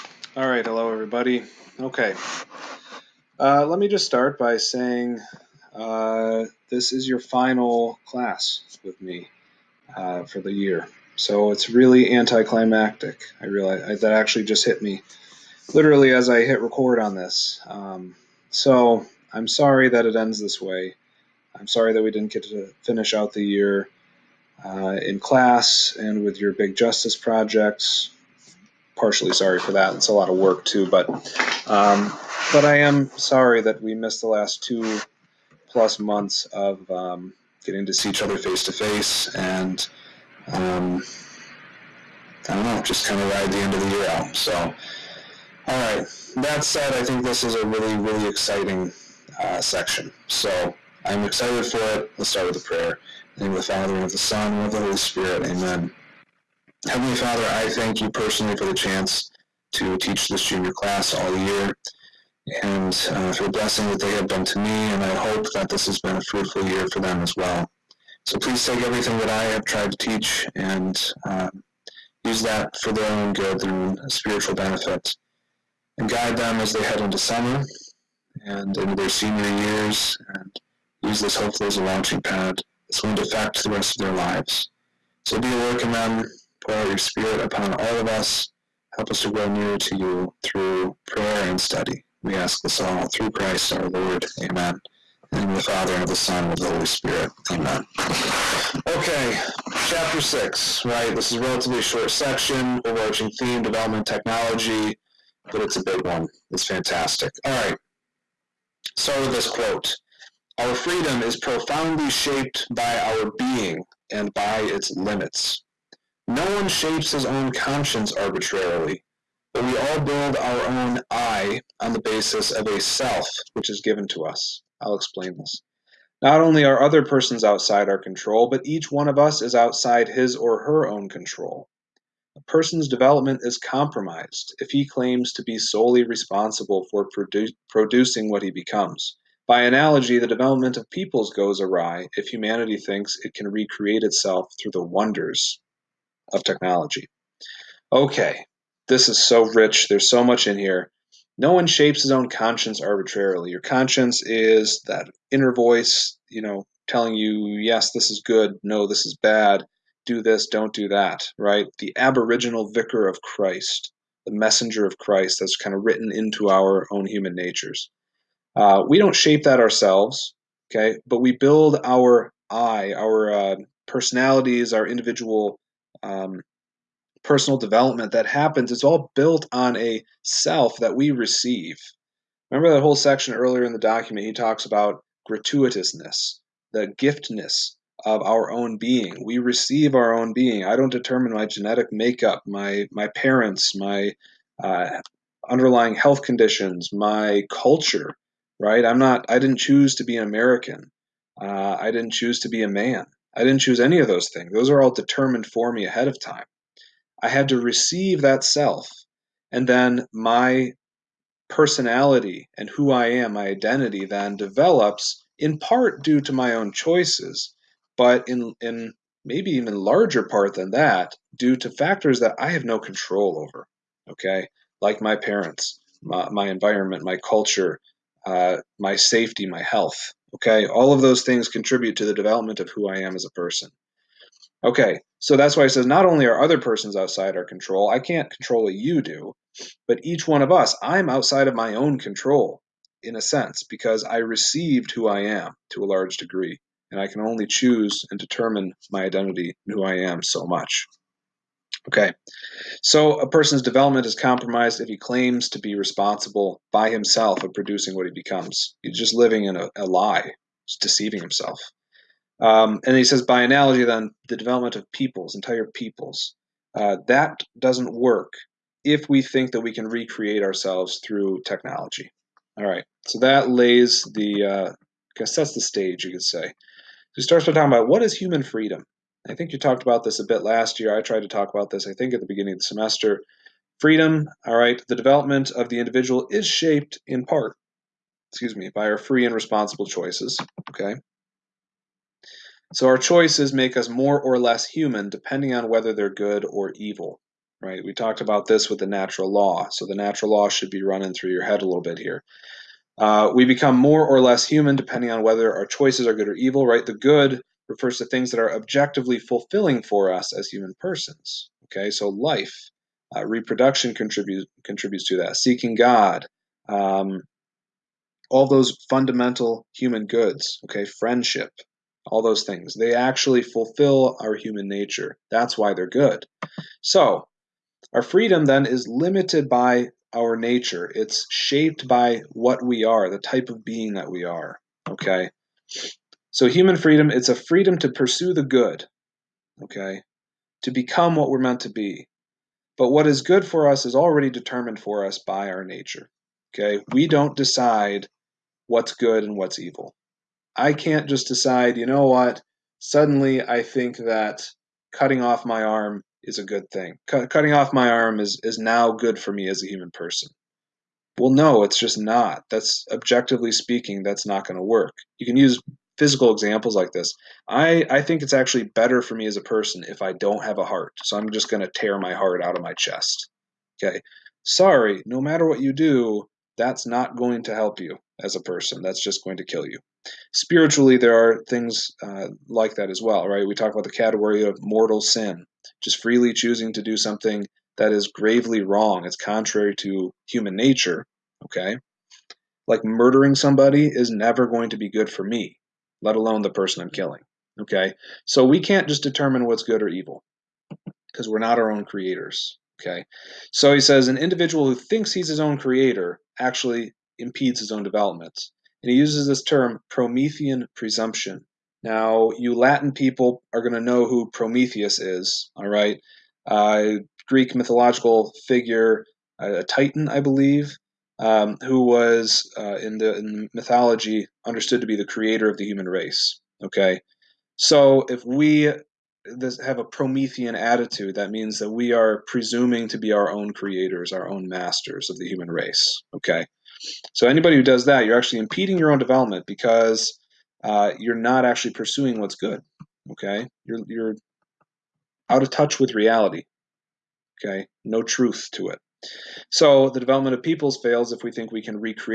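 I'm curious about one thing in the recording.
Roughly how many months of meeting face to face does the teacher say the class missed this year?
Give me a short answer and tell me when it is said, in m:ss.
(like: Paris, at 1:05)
two plus months, at 0:34.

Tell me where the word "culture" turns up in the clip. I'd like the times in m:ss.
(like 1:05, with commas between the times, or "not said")
3:17, 3:47.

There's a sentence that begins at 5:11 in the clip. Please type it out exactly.
Okay, so life, uh, reproduction contributes contributes to that.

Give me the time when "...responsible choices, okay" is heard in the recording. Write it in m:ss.
4:49.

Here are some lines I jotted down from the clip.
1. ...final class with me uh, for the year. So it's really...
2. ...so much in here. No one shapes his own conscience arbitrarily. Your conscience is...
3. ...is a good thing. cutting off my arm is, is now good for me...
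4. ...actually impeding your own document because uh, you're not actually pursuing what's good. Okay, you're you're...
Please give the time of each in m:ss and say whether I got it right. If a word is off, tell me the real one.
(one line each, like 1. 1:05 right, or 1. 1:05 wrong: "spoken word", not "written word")
1. 0:07 right
2. 2:30 right
3. 5:56 right
4. 7:18 wrong: "development", not "document".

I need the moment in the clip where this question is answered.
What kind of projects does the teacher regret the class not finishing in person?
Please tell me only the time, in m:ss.
0:26.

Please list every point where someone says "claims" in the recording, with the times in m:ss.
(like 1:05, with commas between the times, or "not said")
2:14, 4:14.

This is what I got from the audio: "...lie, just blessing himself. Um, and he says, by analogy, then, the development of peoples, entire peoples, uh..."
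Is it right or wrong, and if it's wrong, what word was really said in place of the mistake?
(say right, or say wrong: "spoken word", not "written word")
wrong: "deceiving", not "blessing".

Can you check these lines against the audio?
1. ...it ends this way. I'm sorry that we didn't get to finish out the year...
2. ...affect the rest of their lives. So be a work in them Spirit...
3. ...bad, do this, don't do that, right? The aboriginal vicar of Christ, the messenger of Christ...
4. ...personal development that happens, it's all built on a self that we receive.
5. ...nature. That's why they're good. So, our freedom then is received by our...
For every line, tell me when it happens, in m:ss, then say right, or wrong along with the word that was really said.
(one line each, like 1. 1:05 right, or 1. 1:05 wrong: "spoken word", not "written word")
1. 0:20 right
2. 1:23 wrong: "Pour", not "Spirit"
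3. 2:39 right
4. 2:57 right
5. 5:24 wrong: "limited", not "received".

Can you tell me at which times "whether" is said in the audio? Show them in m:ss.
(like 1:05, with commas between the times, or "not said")
4:55, 5:05.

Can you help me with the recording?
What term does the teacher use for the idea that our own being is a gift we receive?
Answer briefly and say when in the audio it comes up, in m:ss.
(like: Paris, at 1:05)
gratuitousness, at 3:05.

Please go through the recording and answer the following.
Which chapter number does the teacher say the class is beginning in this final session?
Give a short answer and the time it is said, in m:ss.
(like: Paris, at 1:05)
6, at 1:40.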